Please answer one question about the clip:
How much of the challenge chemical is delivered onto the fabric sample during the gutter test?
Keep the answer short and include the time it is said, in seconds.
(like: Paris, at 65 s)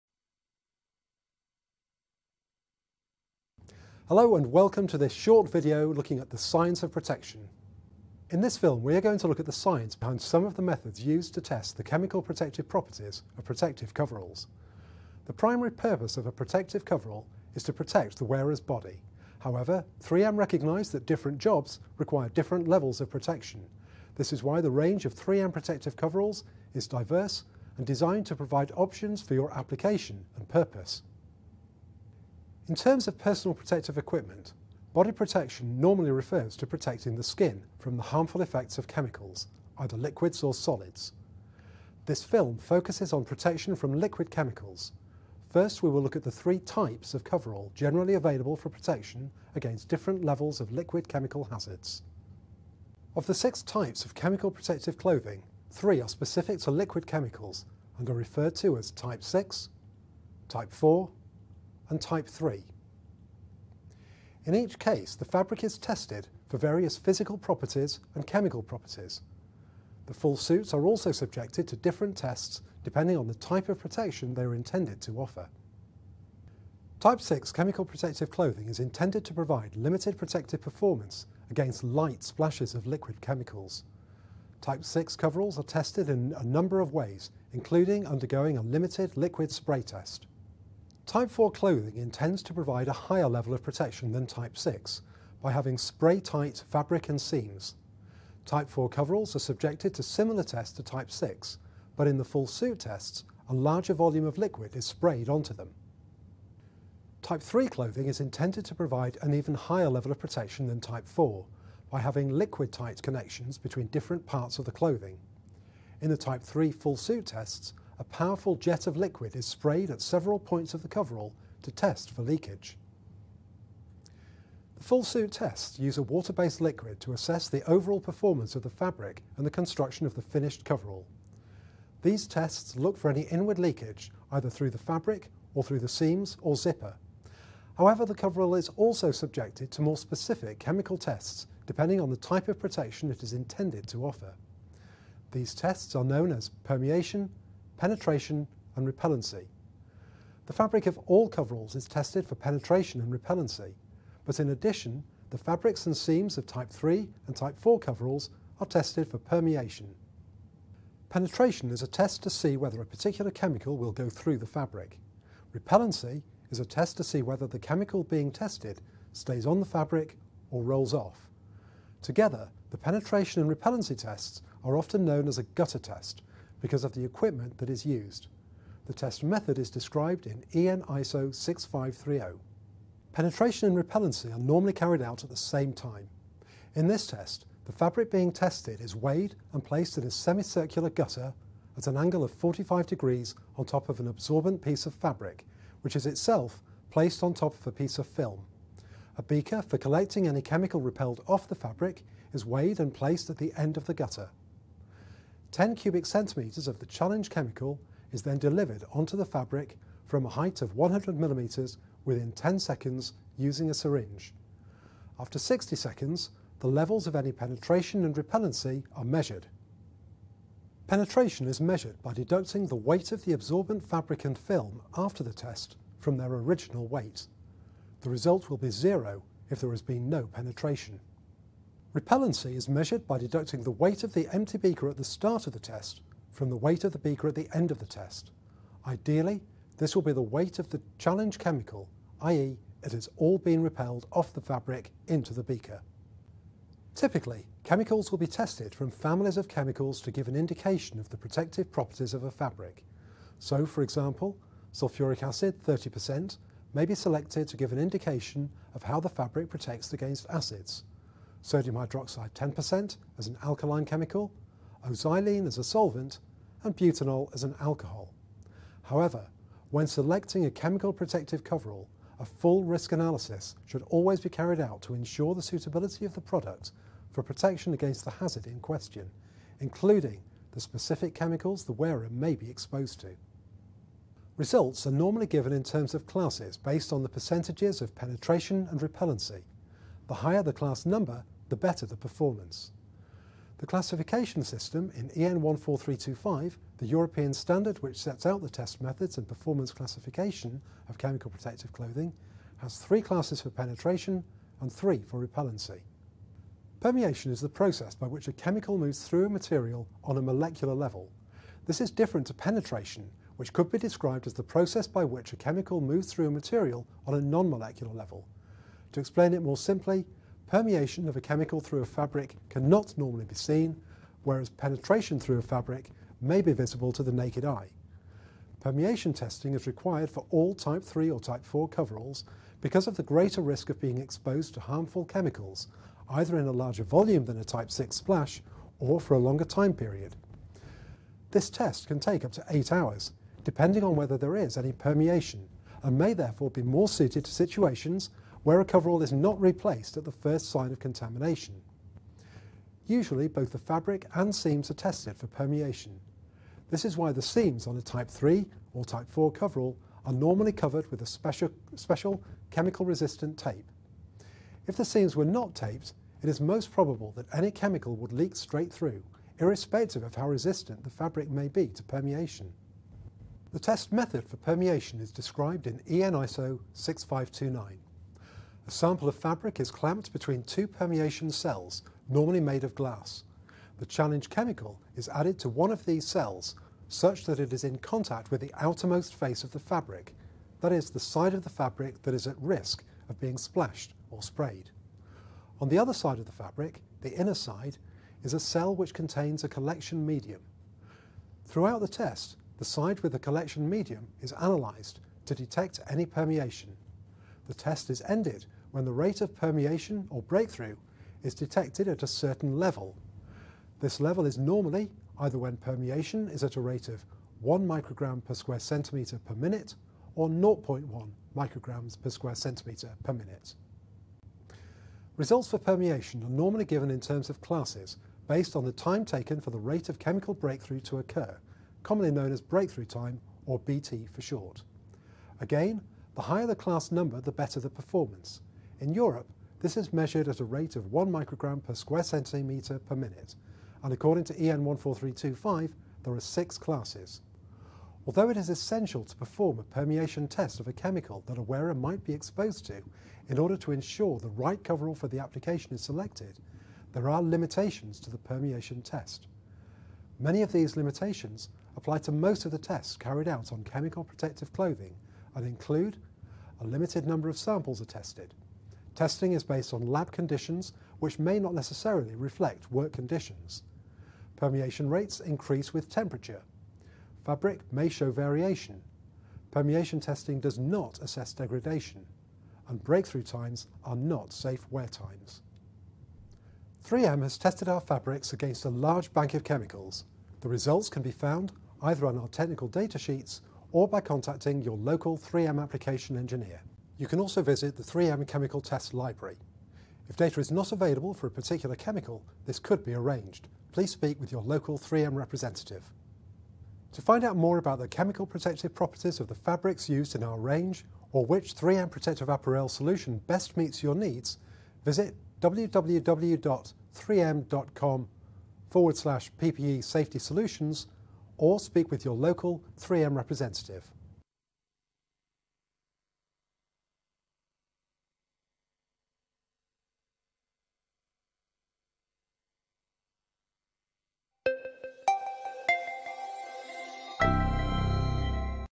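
10 cubic centimetres, at 205 s.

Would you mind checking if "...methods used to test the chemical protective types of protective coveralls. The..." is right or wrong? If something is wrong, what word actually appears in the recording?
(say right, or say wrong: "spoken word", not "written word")
wrong: "properties", not "types".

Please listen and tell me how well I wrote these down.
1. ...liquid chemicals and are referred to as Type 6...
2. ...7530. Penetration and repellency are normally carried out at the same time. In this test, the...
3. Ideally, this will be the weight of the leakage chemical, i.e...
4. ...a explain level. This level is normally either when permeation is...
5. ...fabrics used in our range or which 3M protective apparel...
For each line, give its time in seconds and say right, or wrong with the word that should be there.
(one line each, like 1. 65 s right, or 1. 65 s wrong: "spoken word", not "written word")
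1. 56 s right
2. 181 s wrong: "6530", not "7530"
3. 238 s wrong: "challenge", not "leakage"
4. 412 s wrong: "certain", not "explain"
5. 509 s right.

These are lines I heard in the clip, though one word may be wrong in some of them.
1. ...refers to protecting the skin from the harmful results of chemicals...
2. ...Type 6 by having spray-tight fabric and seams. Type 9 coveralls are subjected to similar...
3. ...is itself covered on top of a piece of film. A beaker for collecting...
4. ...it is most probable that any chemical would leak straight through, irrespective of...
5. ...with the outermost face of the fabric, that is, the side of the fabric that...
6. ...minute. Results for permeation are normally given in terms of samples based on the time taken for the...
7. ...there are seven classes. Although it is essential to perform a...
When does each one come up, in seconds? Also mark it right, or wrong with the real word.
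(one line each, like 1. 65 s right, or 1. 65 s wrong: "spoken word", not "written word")
1. 36 s wrong: "effects", not "results"
2. 94 s wrong: "4", not "9"
3. 195 s wrong: "placed", not "covered"
4. 366 s right
5. 388 s right
6. 423 s wrong: "classes", not "samples"
7. 446 s wrong: "six", not "seven".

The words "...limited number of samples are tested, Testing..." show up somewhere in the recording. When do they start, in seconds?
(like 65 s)
466 s.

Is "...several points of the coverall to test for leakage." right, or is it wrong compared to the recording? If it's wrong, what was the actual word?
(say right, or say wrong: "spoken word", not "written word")
right.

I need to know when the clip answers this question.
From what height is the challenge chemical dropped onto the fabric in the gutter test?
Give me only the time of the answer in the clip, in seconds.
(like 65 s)
210 s.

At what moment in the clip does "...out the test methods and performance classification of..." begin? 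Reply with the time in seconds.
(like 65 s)
298 s.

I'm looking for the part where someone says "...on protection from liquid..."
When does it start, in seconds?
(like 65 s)
43 s.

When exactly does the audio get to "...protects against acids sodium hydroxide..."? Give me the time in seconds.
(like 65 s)
259 s.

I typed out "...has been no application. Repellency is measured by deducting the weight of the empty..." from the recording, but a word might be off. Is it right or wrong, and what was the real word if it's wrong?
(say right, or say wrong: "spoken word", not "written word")
wrong: "penetration", not "application".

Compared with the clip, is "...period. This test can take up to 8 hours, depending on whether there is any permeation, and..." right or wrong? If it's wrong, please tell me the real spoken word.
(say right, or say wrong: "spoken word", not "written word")
right.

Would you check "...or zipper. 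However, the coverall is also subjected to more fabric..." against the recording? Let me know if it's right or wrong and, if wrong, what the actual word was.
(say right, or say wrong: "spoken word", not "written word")
wrong: "specific", not "fabric".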